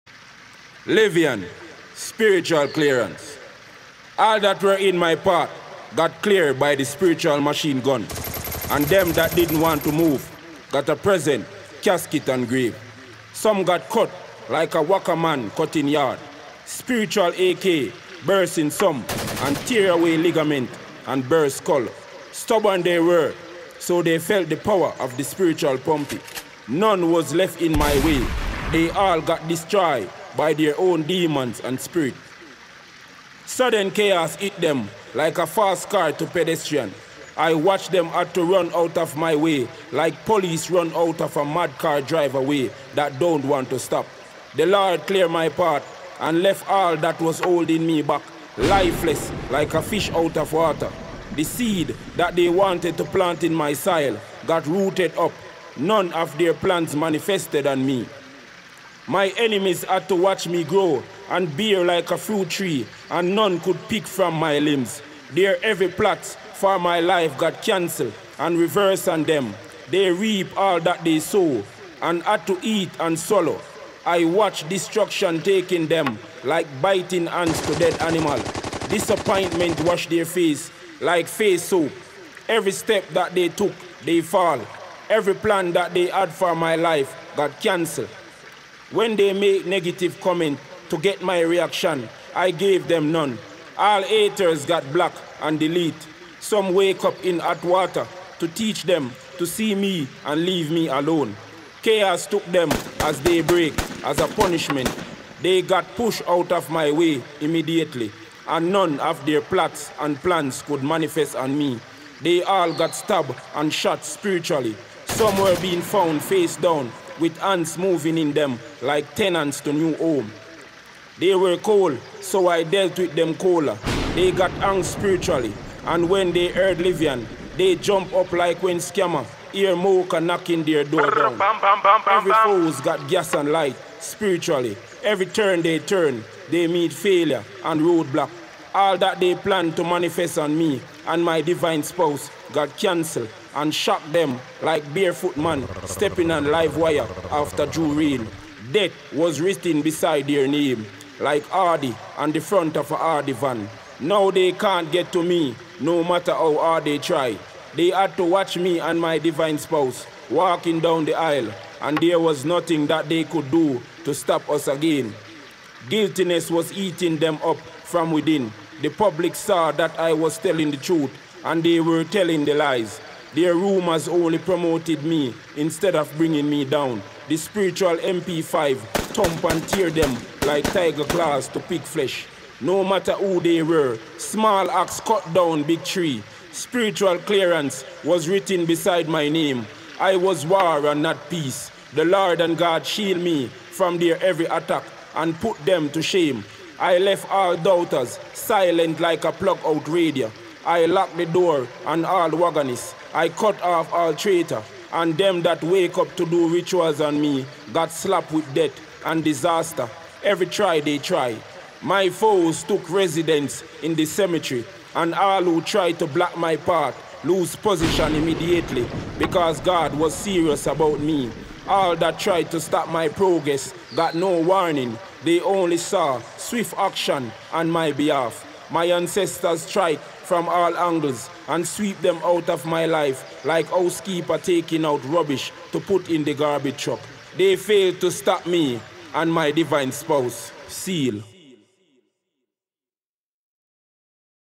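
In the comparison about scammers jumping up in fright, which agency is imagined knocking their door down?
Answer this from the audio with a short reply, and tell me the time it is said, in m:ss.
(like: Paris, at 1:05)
MOCA, at 2:09.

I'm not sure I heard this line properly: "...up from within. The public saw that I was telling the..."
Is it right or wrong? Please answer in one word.
right.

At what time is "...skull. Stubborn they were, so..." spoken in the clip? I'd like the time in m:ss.
0:21.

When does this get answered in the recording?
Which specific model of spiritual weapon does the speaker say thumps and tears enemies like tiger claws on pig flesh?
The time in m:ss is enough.
2:57.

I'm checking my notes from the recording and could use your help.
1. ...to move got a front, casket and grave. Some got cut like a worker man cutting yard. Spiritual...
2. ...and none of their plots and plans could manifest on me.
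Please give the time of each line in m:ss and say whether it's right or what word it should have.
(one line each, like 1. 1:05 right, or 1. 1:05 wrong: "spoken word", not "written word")
1. 0:09 wrong: "present", not "front"
2. 1:48 right.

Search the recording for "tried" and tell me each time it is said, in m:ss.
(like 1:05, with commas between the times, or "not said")
3:35, 3:42, 3:49.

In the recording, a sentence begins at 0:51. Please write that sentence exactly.
The seed that they wanted to plant in my soil got rooted up.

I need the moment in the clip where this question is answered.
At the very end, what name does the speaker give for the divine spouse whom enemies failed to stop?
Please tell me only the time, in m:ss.
4:00.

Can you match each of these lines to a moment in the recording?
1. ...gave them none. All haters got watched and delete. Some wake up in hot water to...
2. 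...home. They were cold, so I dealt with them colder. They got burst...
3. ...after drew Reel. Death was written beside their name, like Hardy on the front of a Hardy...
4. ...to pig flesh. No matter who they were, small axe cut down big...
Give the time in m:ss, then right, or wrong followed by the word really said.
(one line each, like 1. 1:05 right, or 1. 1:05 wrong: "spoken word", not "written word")
1. 1:32 wrong: "blocked", not "watched"
2. 1:59 wrong: "angst", not "burst"
3. 2:27 right
4. 3:01 right.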